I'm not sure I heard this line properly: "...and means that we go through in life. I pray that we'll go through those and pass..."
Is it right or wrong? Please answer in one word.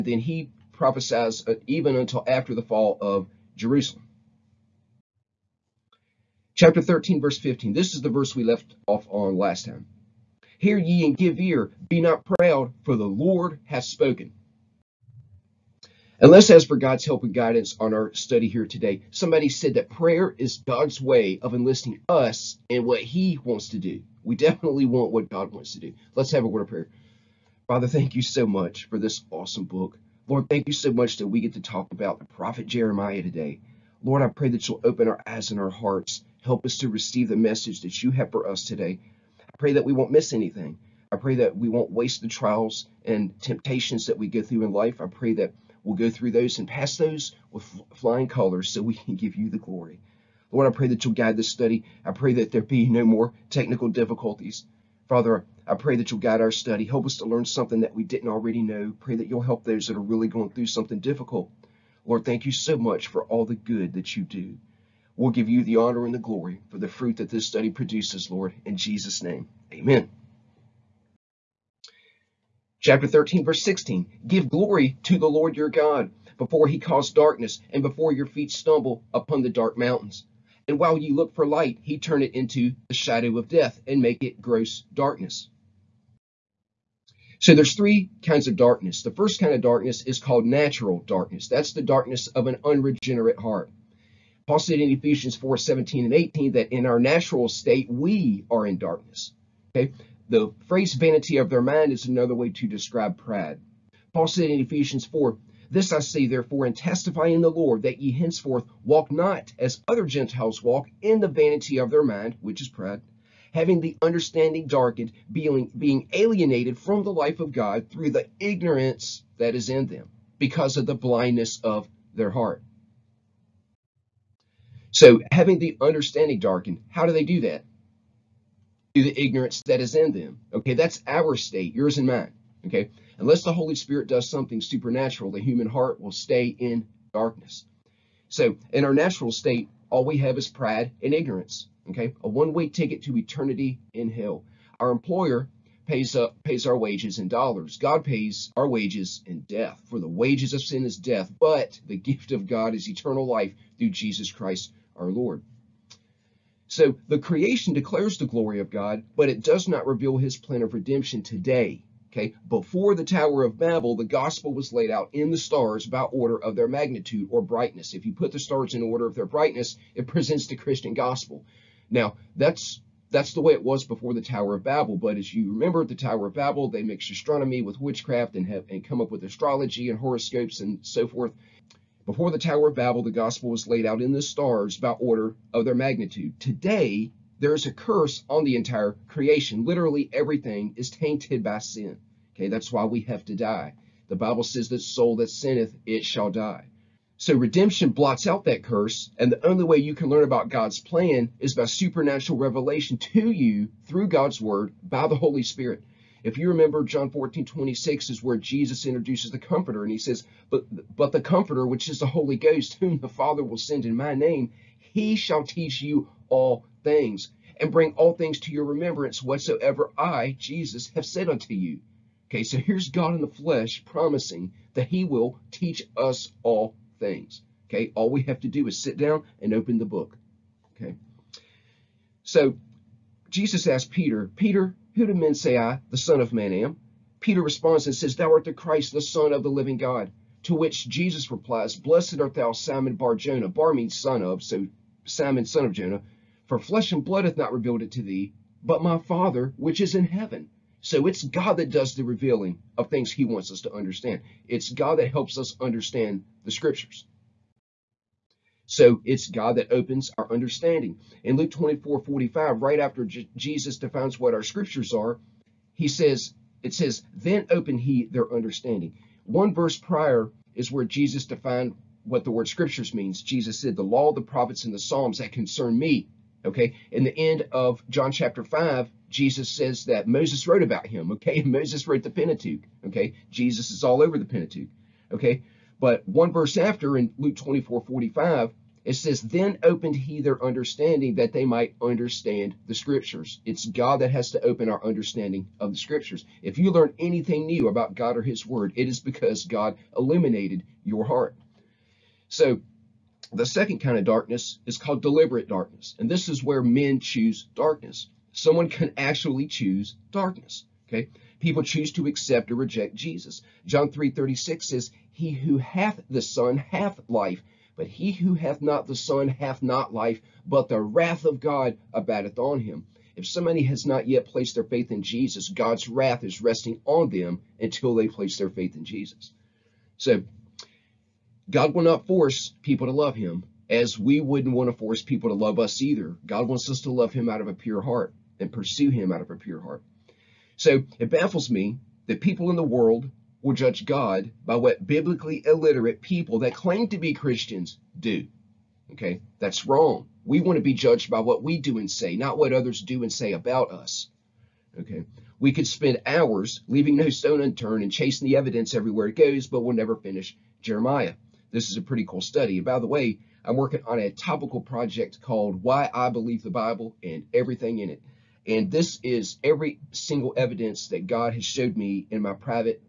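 wrong.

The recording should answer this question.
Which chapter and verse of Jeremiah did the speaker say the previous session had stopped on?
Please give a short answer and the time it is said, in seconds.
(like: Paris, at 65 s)
Chapter 13, verse 15, at 6 s.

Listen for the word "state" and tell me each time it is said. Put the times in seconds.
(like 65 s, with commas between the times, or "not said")
97 s, 131 s, 139 s.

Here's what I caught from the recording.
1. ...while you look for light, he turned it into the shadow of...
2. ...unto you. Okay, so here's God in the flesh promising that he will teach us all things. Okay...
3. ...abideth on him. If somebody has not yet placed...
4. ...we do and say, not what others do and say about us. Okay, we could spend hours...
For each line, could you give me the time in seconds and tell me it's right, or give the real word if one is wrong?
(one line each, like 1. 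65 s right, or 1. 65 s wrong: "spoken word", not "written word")
1. 80 s right
2. 221 s right
3. 321 s right
4. 351 s right.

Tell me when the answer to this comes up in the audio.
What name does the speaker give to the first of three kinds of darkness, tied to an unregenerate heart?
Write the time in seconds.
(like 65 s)
90 s.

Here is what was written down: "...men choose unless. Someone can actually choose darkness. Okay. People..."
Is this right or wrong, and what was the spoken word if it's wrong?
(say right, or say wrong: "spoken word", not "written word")
wrong: "darkness", not "unless".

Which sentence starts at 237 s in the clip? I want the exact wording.
Peter responds and says, Thou art the Christ, the Son of the living God.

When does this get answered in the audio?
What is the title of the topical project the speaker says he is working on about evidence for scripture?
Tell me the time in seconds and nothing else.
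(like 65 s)
365 s.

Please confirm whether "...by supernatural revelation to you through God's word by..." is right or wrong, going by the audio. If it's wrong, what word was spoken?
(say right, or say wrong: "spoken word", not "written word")
right.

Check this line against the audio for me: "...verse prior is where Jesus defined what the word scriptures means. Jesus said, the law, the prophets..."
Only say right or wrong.
right.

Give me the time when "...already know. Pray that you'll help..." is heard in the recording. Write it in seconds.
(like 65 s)
58 s.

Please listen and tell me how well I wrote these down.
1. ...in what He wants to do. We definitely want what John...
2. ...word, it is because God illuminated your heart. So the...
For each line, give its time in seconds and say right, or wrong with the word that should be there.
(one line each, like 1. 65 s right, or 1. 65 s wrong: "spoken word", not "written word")
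1. 22 s wrong: "God", not "John"
2. 298 s right.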